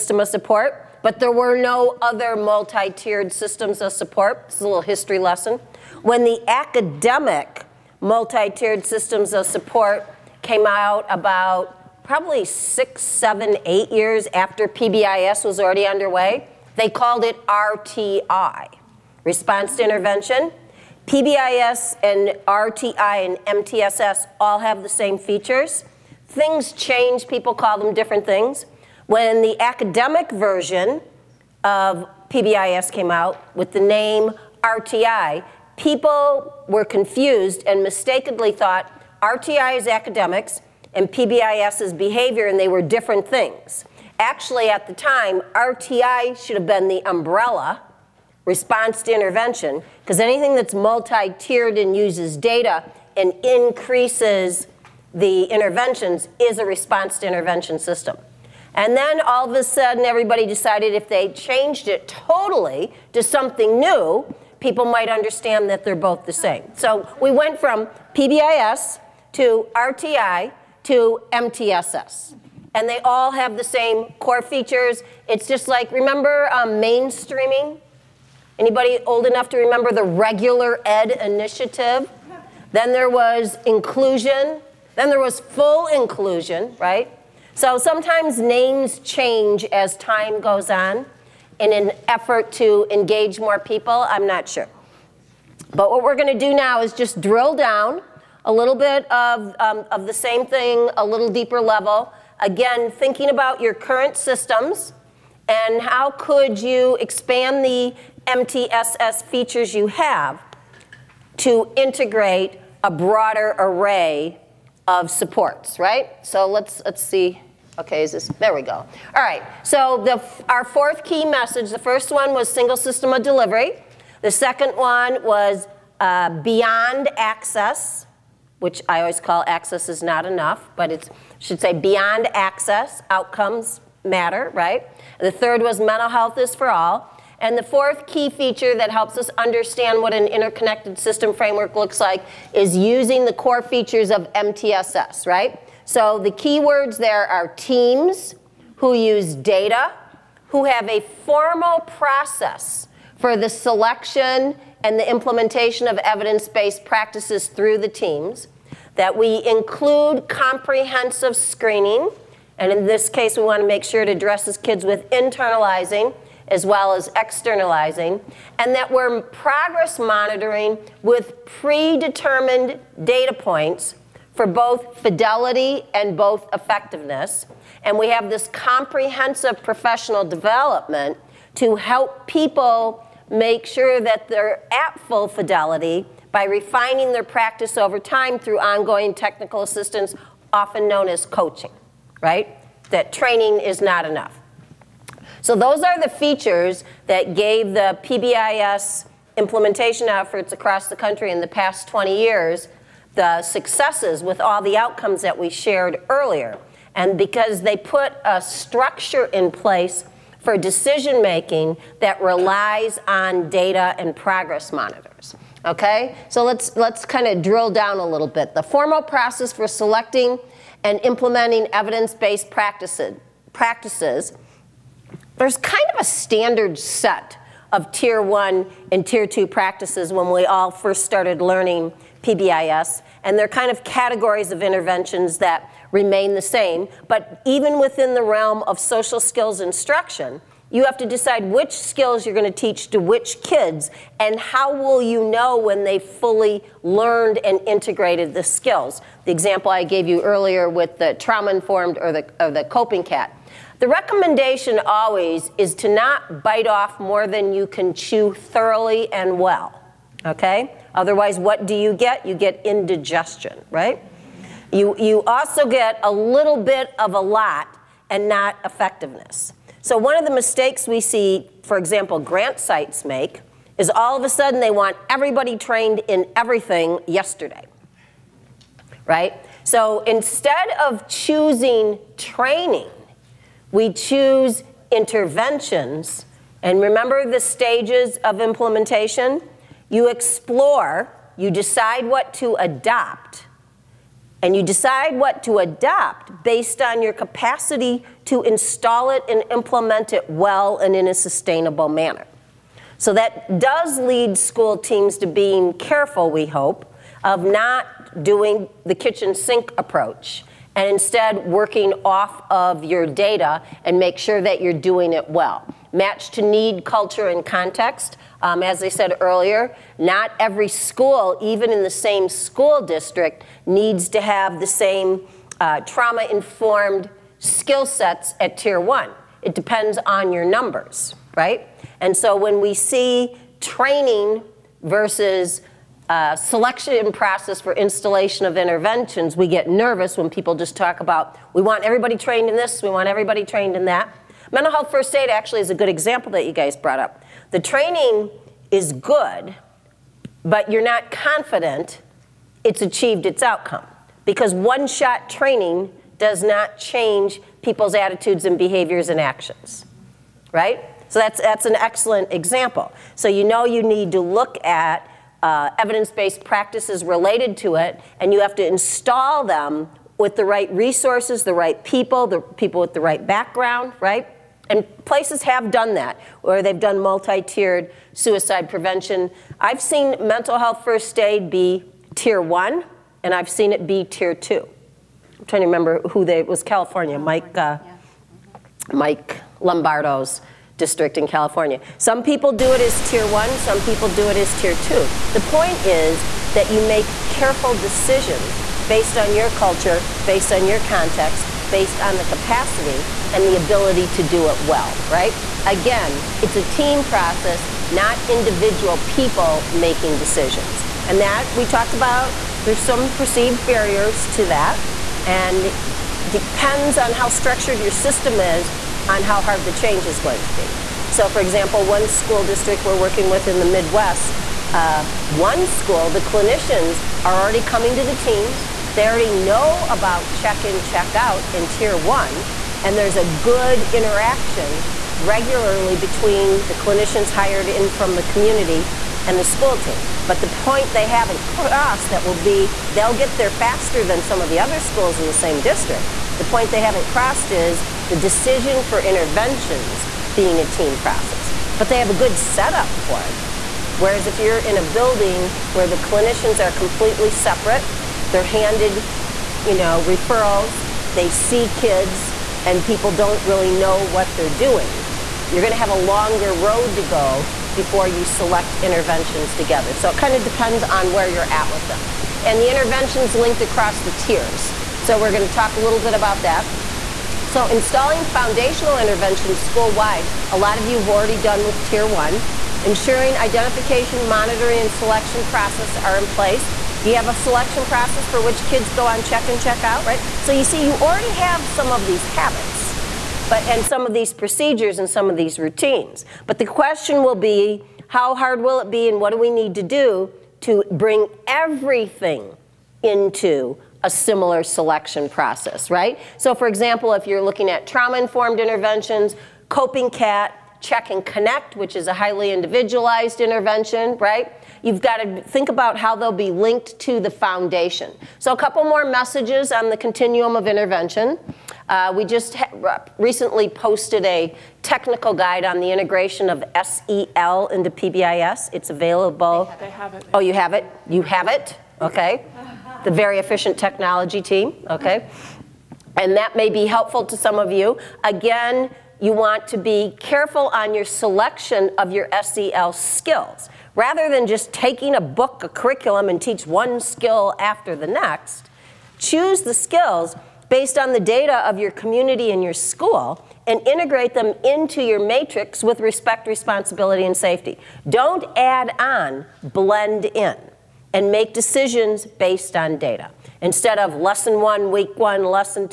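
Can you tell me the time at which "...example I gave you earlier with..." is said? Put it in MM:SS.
04:09.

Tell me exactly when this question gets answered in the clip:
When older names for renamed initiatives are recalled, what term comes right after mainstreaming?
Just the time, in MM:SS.
01:20.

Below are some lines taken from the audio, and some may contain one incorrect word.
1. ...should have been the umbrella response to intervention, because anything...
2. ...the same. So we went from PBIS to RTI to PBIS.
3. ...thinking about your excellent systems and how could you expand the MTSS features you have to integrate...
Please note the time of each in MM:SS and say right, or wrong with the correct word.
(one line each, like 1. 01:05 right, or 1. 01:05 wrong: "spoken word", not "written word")
1. 00:46 right
2. 01:06 wrong: "MTSS", not "PBIS"
3. 01:42 wrong: "current", not "excellent".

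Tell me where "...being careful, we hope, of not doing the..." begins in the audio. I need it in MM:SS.
05:05.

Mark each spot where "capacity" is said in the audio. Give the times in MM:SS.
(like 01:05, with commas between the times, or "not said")
04:57, 06:42.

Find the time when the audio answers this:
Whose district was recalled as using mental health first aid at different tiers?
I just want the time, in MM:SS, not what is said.
06:28.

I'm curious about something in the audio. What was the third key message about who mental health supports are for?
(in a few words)
mental health is for all.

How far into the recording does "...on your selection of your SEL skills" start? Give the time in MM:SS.
09:00.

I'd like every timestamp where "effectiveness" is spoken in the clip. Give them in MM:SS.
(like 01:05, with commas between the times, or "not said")
02:56, 04:28.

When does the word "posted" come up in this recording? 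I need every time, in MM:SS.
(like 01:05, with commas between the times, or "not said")
08:43.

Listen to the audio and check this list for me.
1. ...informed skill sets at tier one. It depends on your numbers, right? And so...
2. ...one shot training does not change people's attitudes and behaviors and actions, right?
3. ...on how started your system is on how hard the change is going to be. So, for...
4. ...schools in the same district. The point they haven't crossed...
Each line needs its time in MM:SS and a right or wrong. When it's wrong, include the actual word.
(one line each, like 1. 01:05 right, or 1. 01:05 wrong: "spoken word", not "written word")
1. 05:26 right
2. 05:54 right
3. 06:56 wrong: "structured", not "started"
4. 07:24 right.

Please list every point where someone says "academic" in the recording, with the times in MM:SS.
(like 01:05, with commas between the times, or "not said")
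00:06, 00:29, 00:39.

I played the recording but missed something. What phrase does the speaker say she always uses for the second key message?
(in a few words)
access is not enough.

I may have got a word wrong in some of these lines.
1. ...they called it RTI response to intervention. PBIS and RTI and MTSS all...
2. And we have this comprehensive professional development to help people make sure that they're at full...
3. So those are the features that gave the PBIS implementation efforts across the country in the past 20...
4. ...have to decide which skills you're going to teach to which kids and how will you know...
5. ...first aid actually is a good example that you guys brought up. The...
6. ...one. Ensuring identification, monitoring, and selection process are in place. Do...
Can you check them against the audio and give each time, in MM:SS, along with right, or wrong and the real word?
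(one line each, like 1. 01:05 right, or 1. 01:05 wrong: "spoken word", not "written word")
1. 00:16 right
2. 02:57 right
3. 03:15 right
4. 04:00 right
5. 05:44 right
6. 08:02 right.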